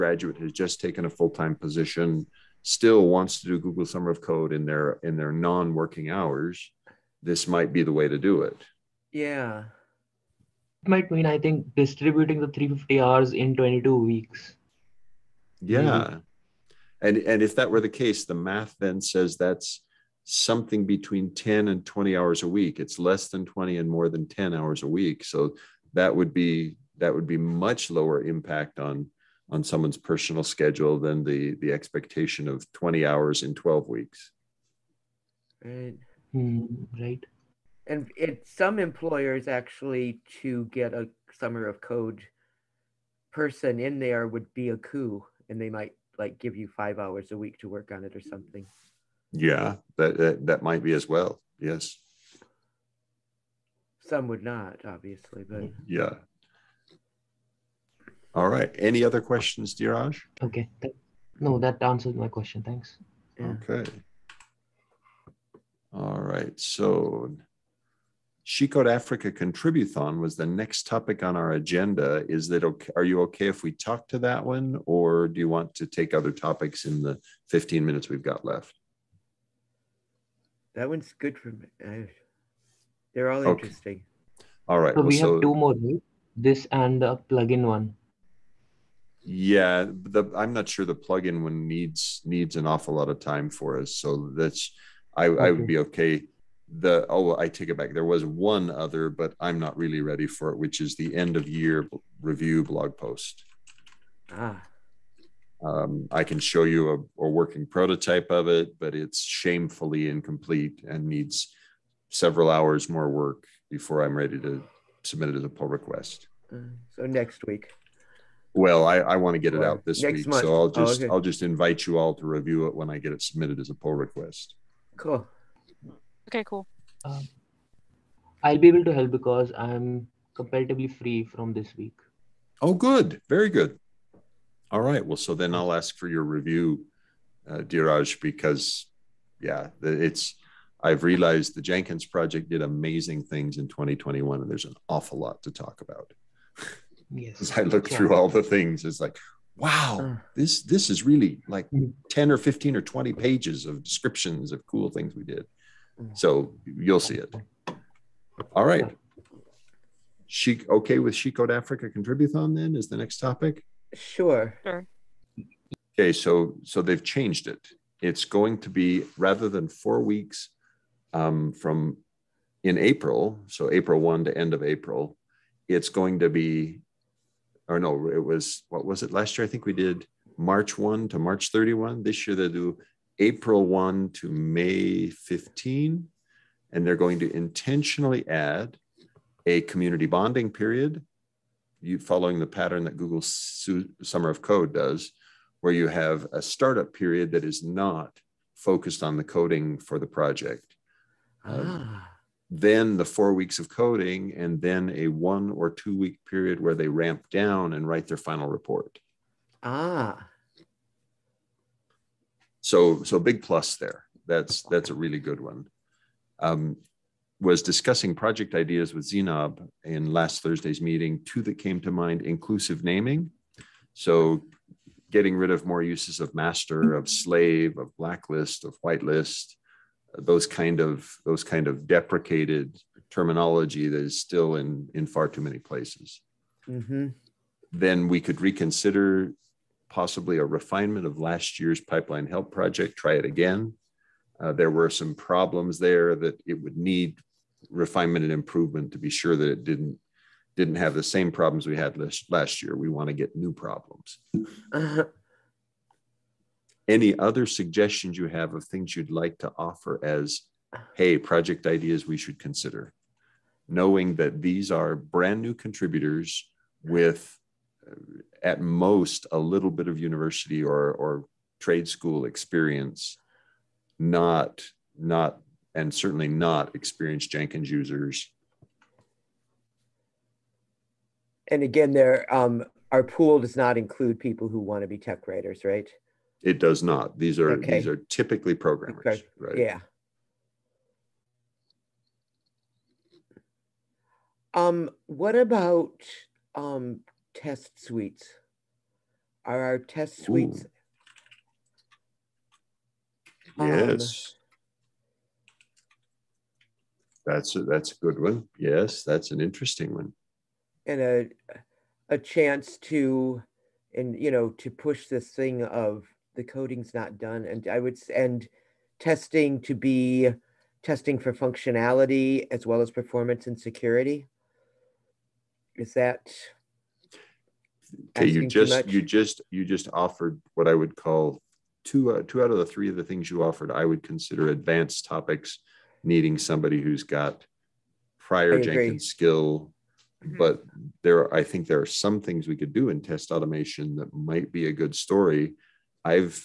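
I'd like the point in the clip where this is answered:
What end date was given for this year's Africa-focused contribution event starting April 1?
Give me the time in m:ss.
3:04.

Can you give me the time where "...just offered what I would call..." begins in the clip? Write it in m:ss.
5:29.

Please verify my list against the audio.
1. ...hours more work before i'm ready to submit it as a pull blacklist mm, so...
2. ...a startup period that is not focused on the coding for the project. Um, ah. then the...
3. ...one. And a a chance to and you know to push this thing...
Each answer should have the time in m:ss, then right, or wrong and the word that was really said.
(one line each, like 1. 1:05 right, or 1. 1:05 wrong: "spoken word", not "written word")
1. 1:52 wrong: "request", not "blacklist"
2. 3:16 right
3. 5:09 right.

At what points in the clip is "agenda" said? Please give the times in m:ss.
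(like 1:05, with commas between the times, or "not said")
1:11.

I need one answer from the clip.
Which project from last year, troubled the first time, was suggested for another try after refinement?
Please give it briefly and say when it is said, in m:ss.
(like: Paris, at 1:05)
pipeline help, at 4:01.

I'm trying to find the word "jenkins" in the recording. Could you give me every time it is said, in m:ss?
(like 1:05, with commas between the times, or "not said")
2:21, 4:37, 5:38.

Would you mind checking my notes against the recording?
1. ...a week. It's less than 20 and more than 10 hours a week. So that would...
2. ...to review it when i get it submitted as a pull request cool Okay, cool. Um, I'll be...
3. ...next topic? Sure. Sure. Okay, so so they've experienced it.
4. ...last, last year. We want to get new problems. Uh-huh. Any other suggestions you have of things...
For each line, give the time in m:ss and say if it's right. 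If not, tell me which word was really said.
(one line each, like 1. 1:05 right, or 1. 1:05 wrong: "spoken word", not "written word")
1. 0:22 right
2. 2:02 right
3. 2:42 wrong: "changed", not "experienced"
4. 4:11 right.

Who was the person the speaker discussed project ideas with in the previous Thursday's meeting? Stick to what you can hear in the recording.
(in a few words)
Zainab.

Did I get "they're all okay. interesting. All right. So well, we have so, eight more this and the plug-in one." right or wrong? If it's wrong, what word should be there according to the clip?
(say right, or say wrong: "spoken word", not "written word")
wrong: "two", not "eight".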